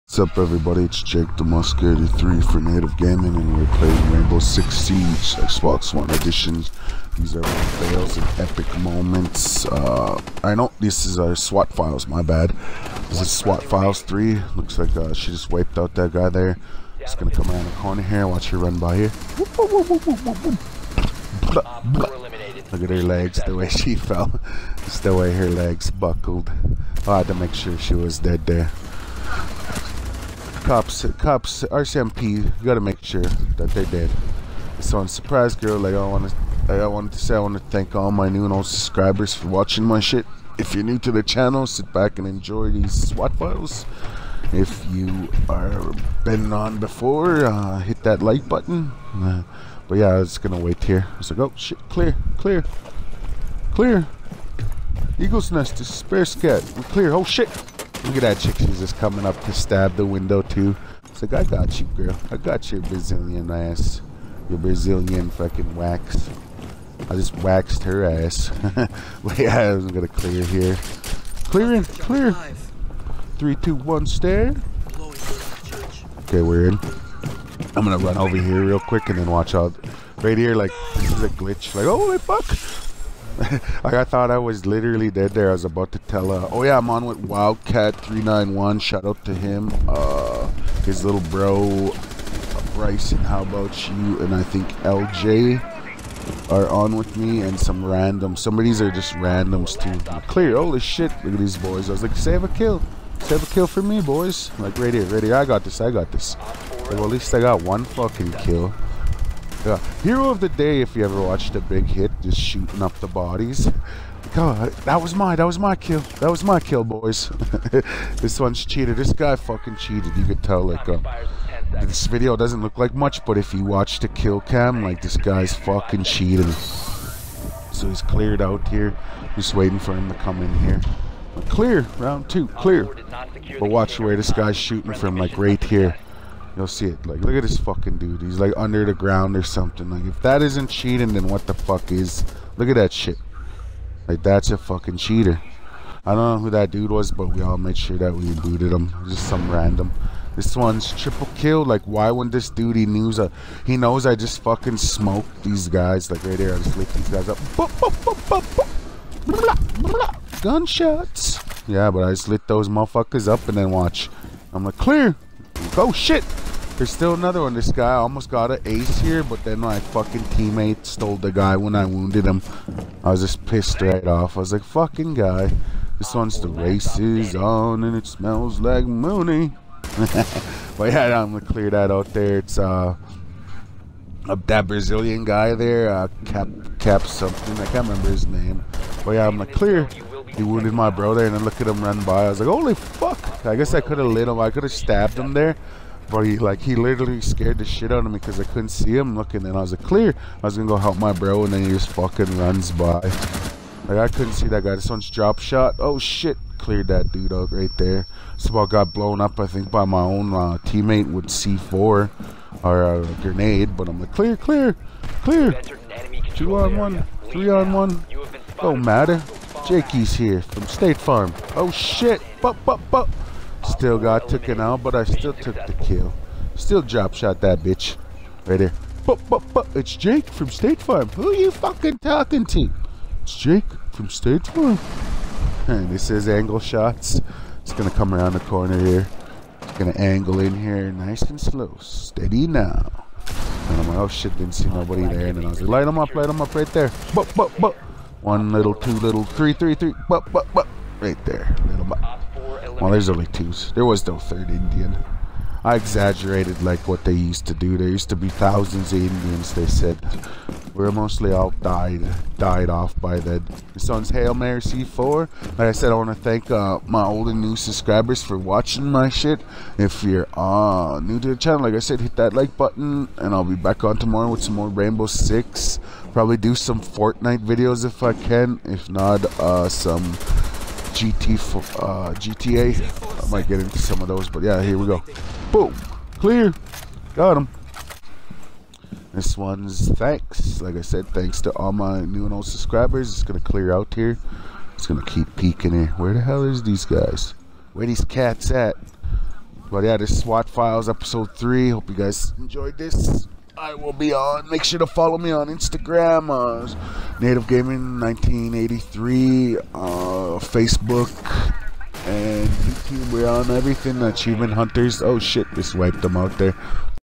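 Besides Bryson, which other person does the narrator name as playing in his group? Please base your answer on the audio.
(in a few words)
LJ.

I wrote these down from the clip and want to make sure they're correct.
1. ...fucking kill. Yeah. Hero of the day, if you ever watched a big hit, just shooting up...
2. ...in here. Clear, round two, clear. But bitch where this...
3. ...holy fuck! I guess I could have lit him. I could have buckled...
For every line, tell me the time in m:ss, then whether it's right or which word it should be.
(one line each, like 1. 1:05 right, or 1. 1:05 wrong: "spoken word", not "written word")
1. 1:47 right
2. 2:10 wrong: "watch", not "bitch"
3. 3:12 wrong: "stabbed", not "buckled".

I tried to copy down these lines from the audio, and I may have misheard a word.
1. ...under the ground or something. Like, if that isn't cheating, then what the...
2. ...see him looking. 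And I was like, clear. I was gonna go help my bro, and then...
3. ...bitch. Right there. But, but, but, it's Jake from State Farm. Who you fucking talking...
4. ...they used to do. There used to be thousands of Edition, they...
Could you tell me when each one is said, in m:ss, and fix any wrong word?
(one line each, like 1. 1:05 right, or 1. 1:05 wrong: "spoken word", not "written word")
1. 2:18 right
2. 3:18 right
3. 3:47 right
4. 4:17 wrong: "Indians", not "Edition".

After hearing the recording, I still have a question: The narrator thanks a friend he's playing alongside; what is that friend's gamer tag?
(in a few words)
Wildcat391.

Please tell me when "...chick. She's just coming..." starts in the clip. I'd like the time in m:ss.
0:58.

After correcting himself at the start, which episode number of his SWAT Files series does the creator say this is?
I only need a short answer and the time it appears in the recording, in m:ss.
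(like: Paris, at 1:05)
3, at 0:13.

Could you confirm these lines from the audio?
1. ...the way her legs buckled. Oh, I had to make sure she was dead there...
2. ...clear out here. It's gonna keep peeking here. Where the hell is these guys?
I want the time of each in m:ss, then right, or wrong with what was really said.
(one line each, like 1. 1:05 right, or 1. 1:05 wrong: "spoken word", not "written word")
1. 0:25 right
2. 4:53 right.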